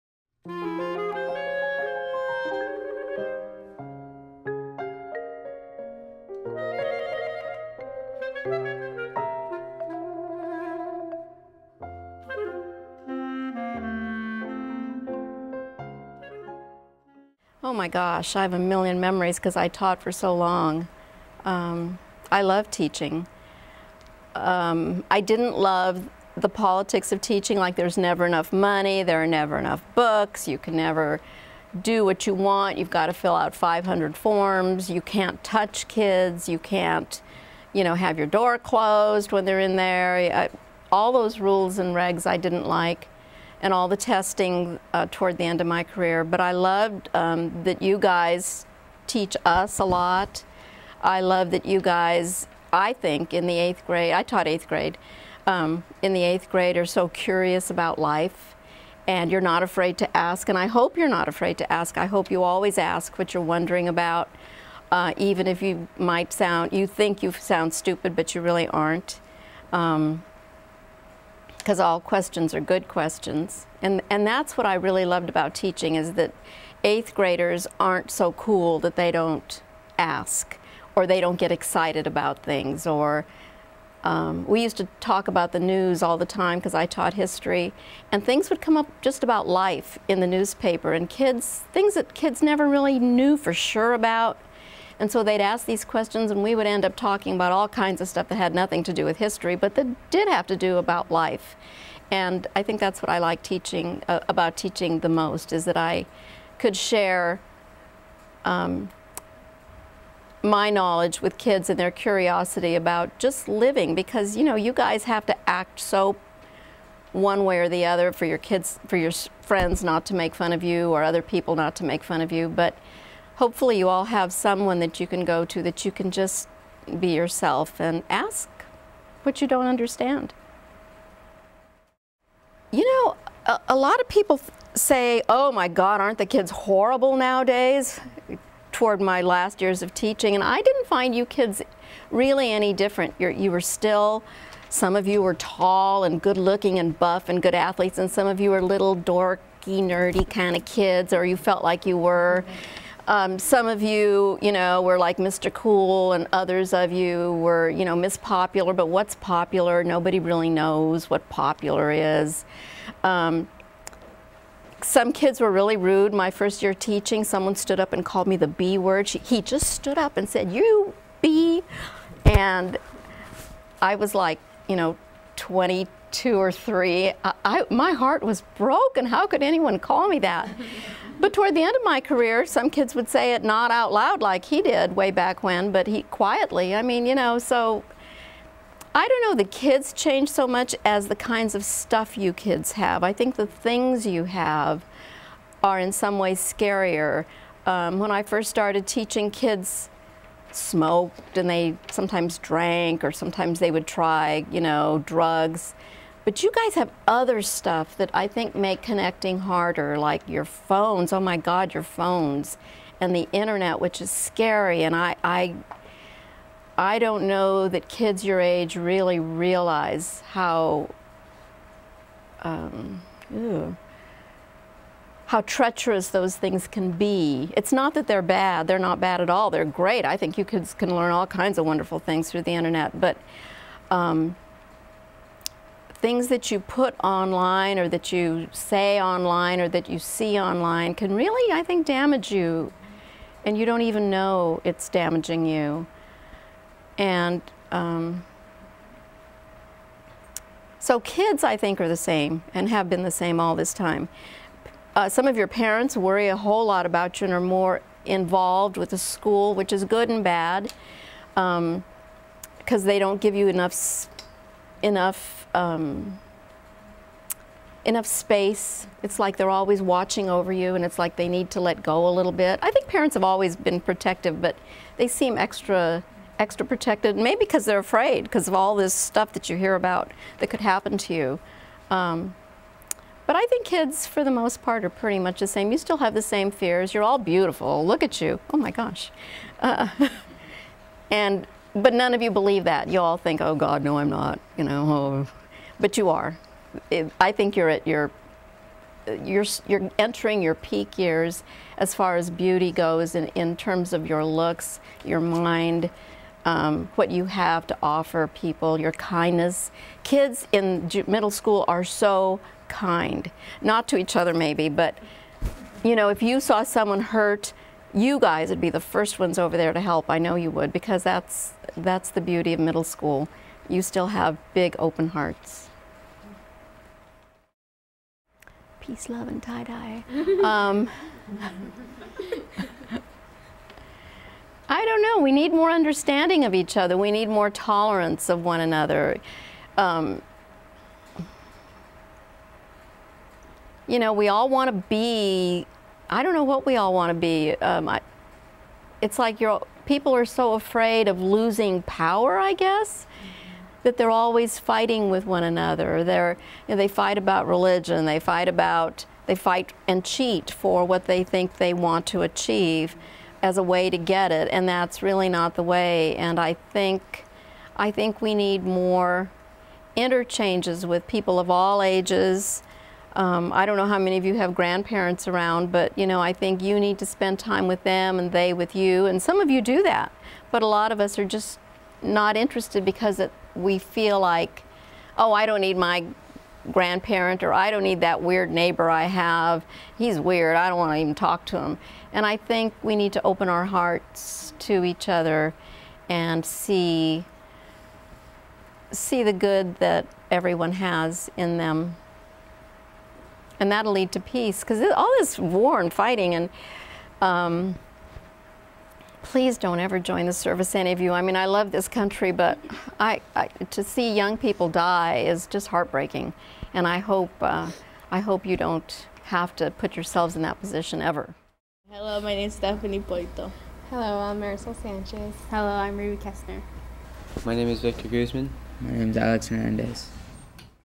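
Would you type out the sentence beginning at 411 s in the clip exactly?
I mean, I love this country, but I, I to see young people die is just heartbreaking.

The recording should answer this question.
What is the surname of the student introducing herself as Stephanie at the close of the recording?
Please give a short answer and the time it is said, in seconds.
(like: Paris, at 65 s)
Poito, at 423 s.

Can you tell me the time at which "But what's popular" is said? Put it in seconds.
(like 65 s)
158 s.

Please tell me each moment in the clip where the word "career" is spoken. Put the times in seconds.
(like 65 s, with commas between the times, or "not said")
45 s, 181 s.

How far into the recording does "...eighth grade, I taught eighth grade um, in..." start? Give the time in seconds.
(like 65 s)
53 s.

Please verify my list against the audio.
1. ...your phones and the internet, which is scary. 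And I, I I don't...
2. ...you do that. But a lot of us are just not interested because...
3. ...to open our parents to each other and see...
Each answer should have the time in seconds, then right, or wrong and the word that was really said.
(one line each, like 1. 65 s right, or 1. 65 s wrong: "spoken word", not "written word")
1. 211 s right
2. 379 s right
3. 393 s wrong: "hearts", not "parents".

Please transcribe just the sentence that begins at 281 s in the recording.
Um, but I think kids, for the most part, are pretty much the same.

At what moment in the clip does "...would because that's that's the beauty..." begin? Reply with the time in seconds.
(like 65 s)
320 s.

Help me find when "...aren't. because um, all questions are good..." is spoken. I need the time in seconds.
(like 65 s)
68 s.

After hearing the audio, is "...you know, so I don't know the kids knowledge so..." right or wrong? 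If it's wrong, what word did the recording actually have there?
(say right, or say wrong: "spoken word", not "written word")
wrong: "change", not "knowledge".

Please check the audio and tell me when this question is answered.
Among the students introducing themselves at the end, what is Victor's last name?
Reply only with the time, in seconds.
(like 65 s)
428 s.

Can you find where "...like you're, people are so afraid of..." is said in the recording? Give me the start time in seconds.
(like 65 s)
349 s.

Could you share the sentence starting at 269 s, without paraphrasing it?
It's like they're always watching over you, and it's like they need to let go a little bit.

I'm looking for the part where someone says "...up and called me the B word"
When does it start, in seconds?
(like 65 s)
167 s.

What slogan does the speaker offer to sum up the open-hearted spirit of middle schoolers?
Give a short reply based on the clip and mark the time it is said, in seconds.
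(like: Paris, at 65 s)
Peace, love, and tie dye, at 328 s.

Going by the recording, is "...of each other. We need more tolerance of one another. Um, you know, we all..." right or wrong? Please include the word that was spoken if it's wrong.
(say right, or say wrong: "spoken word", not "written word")
right.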